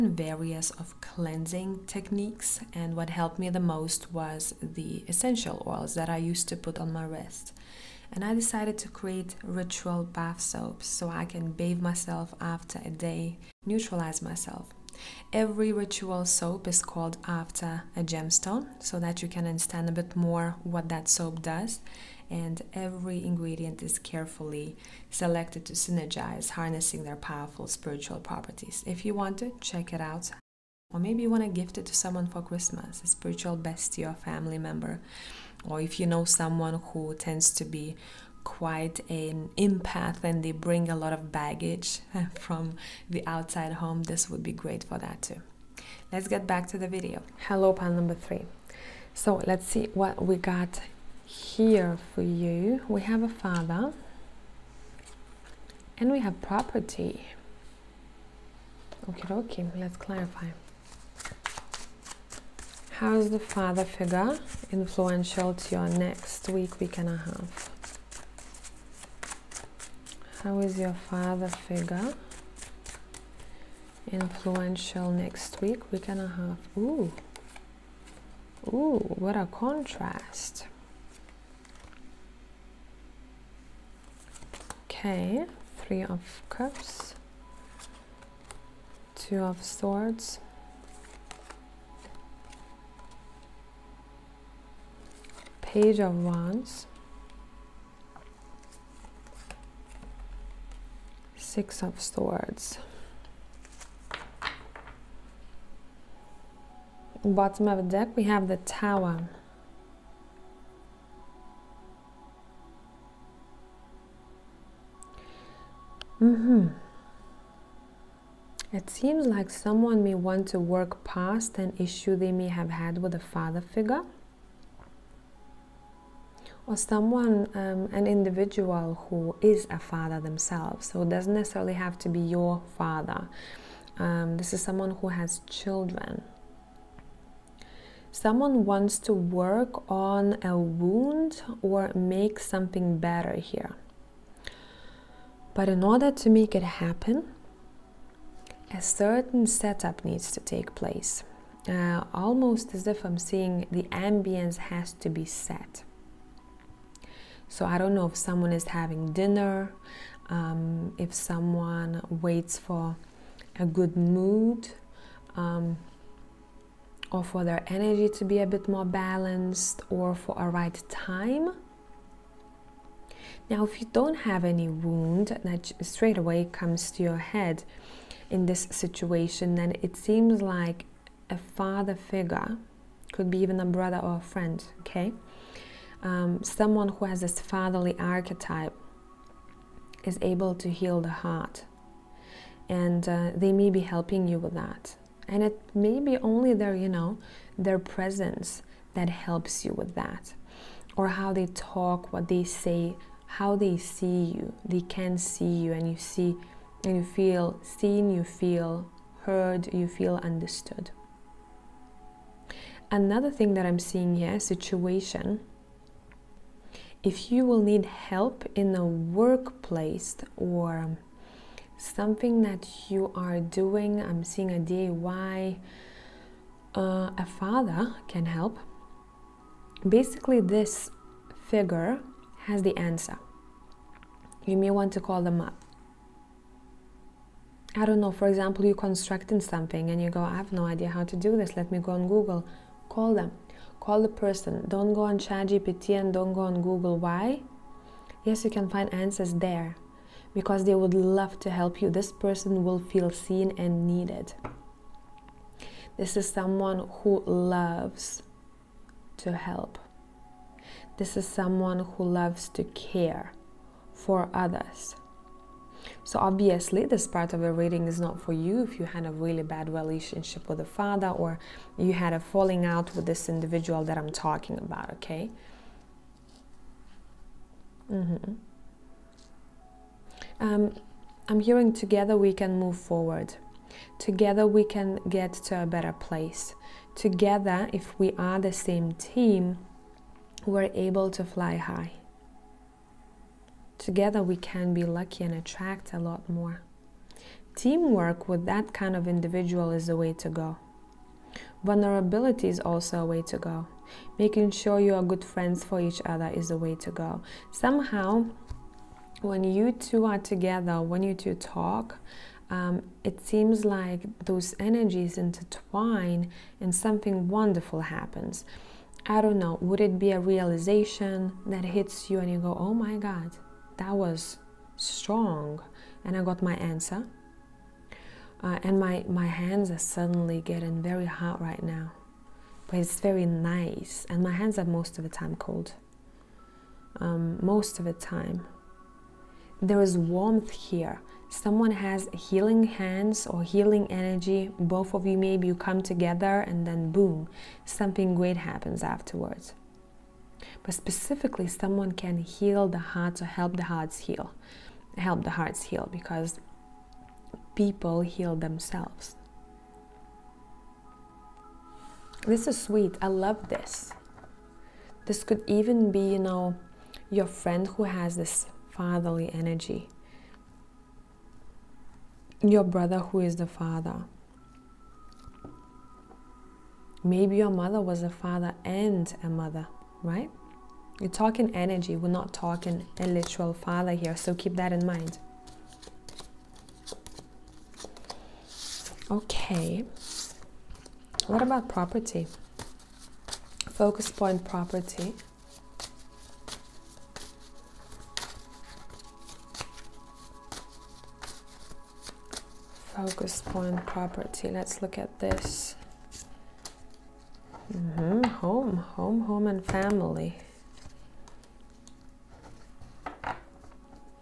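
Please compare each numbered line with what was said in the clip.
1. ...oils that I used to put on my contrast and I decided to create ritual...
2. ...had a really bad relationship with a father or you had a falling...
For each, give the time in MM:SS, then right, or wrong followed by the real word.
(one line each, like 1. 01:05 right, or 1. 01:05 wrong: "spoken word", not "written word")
1. 00:05 wrong: "wrist", not "contrast"
2. 04:28 right.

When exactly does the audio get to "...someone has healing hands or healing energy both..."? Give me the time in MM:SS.
05:41.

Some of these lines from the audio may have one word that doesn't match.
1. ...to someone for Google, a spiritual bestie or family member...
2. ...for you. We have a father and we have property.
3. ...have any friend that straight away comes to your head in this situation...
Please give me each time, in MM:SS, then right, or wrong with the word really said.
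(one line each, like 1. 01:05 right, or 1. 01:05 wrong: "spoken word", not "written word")
1. 00:31 wrong: "Christmas", not "Google"
2. 00:52 right
3. 02:54 wrong: "wound", not "friend".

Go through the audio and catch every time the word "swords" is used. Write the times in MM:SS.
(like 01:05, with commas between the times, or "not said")
01:29, 01:41.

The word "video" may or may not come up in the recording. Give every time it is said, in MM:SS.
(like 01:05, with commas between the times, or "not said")
00:46.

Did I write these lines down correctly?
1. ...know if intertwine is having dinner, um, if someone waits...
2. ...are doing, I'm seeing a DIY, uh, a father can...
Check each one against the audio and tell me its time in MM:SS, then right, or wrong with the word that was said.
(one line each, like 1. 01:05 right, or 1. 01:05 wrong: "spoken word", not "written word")
1. 02:37 wrong: "someone", not "intertwine"
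2. 03:43 right.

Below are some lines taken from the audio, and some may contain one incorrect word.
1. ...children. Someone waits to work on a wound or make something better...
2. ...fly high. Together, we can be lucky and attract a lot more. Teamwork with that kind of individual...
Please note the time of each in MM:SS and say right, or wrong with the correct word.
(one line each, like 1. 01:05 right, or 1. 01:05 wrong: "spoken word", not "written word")
1. 02:15 wrong: "wants", not "waits"
2. 04:51 right.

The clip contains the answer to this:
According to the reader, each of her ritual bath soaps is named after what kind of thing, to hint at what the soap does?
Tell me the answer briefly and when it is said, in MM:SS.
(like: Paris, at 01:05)
A gemstone, at 00:17.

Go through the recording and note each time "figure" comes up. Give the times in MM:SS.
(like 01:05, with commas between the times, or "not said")
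01:03, 01:11, 02:03, 03:01, 03:51.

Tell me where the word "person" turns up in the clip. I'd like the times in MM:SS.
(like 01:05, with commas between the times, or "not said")
04:04, 04:12.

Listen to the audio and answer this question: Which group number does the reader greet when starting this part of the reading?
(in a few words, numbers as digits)
Pile 3.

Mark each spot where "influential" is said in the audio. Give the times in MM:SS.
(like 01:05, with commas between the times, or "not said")
01:04, 01:14.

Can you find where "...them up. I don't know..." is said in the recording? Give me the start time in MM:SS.
03:55.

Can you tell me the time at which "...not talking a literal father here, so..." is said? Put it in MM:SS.
06:22.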